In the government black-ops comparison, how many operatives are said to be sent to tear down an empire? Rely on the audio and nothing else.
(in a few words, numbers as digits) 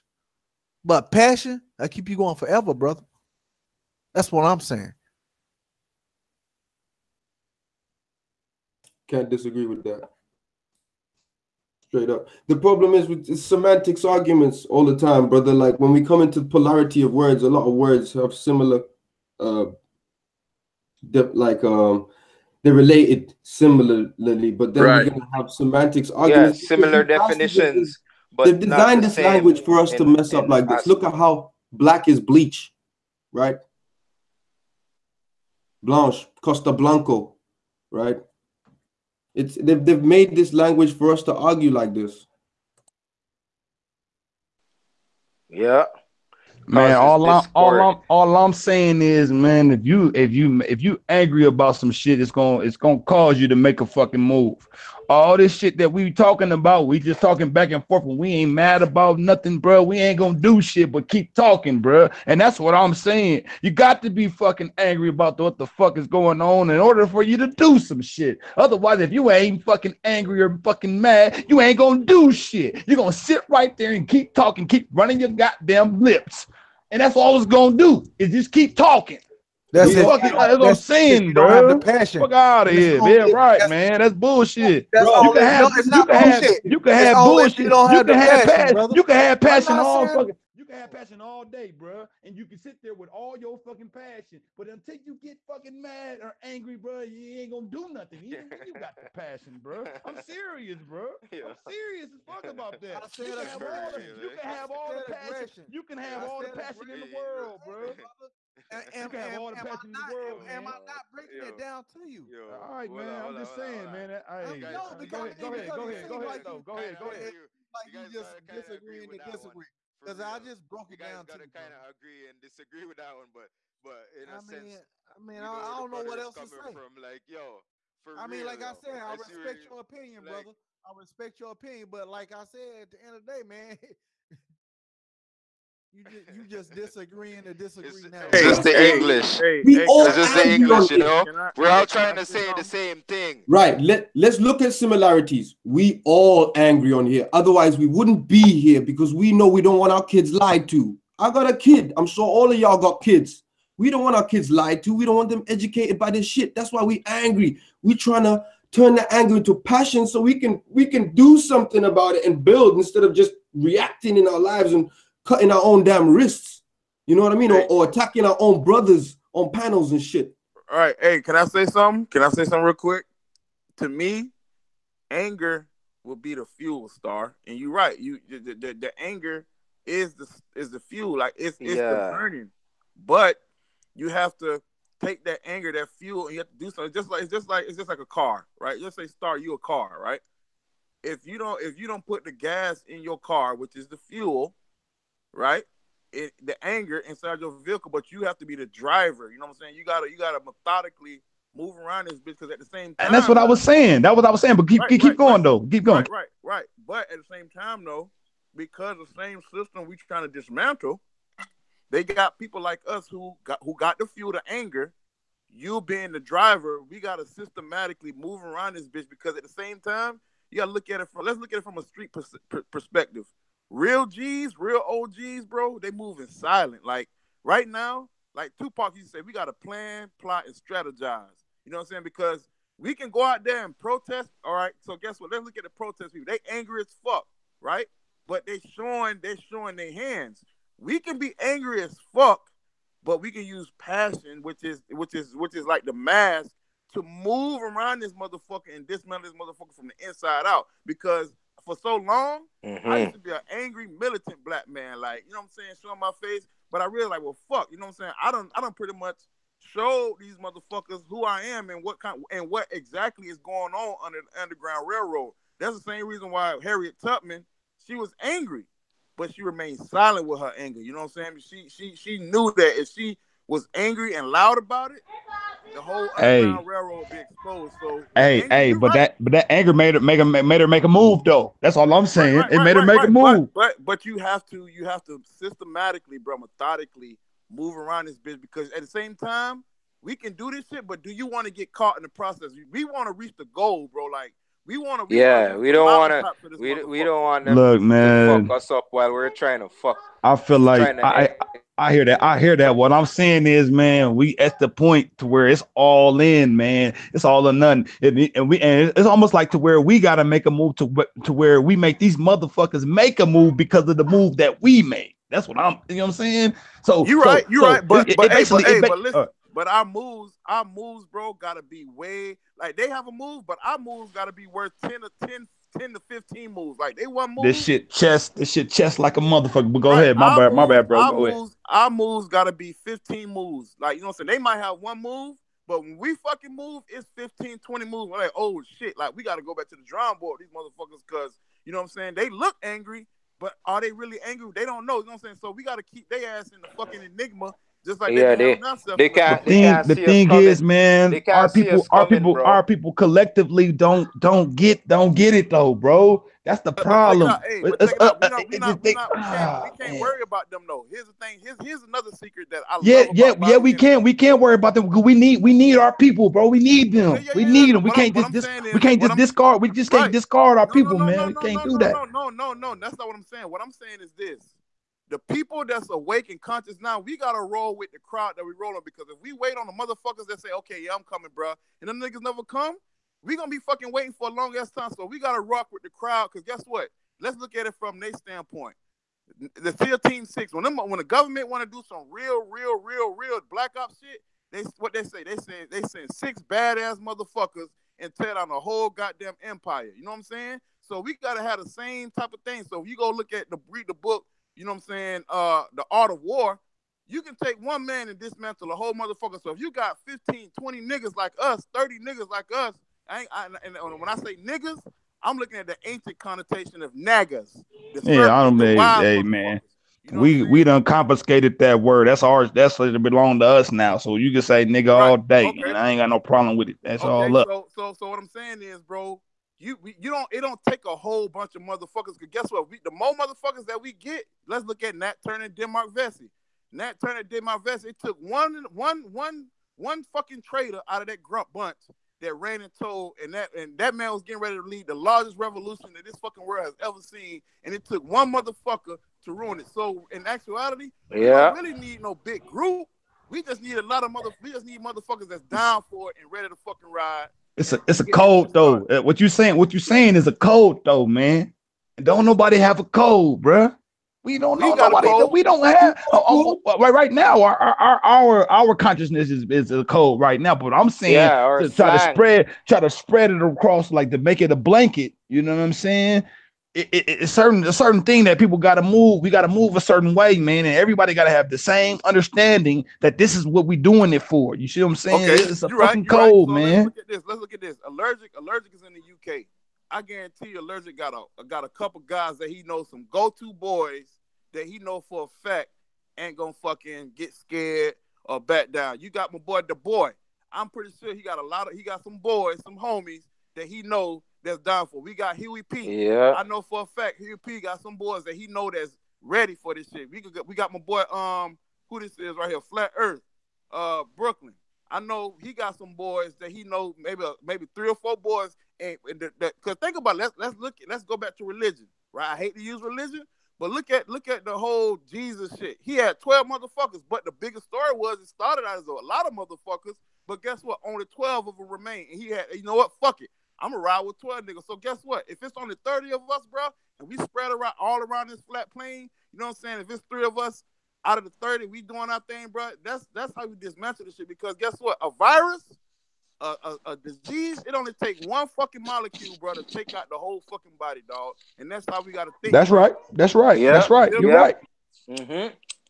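6.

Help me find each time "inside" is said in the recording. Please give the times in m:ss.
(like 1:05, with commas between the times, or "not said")
3:16, 4:10.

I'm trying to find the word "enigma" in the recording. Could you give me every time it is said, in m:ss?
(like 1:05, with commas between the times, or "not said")
5:47.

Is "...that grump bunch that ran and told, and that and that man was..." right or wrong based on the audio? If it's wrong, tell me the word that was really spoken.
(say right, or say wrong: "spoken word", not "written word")
right.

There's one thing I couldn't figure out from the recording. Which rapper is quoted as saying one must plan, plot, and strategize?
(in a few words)
Tupac.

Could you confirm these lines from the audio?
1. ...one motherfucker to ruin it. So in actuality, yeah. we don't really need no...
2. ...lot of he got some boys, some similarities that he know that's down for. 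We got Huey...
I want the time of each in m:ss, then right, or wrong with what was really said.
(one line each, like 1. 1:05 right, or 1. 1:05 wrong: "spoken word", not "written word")
1. 7:28 right
2. 8:21 wrong: "homies", not "similarities".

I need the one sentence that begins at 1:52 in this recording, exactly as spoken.
Well, I'm well, just saying, man.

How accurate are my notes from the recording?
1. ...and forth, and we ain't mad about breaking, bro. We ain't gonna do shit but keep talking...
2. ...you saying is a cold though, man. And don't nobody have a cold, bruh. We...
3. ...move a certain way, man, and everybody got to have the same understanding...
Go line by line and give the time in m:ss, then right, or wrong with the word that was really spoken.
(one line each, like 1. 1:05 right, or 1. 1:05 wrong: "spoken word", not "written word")
1. 0:57 wrong: "nothing", not "breaking"
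2. 7:39 right
3. 7:59 right.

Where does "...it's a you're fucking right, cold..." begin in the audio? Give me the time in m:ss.
8:05.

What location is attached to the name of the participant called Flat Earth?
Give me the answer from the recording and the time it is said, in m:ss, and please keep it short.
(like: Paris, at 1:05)
Brooklyn, at 8:34.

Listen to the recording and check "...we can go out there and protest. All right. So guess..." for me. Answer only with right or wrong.
right.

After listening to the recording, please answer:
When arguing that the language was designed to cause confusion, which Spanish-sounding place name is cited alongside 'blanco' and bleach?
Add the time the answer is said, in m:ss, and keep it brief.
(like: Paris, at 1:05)
Costa Blanco, at 0:36.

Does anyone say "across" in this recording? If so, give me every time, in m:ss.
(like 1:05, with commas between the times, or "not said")
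7:53.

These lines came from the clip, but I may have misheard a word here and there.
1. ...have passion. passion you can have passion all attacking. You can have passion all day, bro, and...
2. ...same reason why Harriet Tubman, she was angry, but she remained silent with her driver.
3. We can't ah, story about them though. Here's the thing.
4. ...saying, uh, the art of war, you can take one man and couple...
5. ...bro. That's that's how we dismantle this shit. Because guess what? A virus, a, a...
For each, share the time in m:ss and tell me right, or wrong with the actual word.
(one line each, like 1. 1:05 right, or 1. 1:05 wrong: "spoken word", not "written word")
1. 1:28 wrong: "fucking", not "attacking"
2. 4:25 wrong: "anger", not "driver"
3. 5:57 wrong: "worry", not "story"
4. 6:44 wrong: "dismantle", not "couple"
5. 9:02 right.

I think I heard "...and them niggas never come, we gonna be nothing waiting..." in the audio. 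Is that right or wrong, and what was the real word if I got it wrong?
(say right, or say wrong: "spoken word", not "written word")
wrong: "fucking", not "nothing".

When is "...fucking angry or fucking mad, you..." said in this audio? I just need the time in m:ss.
1:09.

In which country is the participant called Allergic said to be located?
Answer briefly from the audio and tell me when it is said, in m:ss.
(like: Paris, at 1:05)
UK, at 8:09.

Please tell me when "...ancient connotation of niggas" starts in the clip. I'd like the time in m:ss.
6:55.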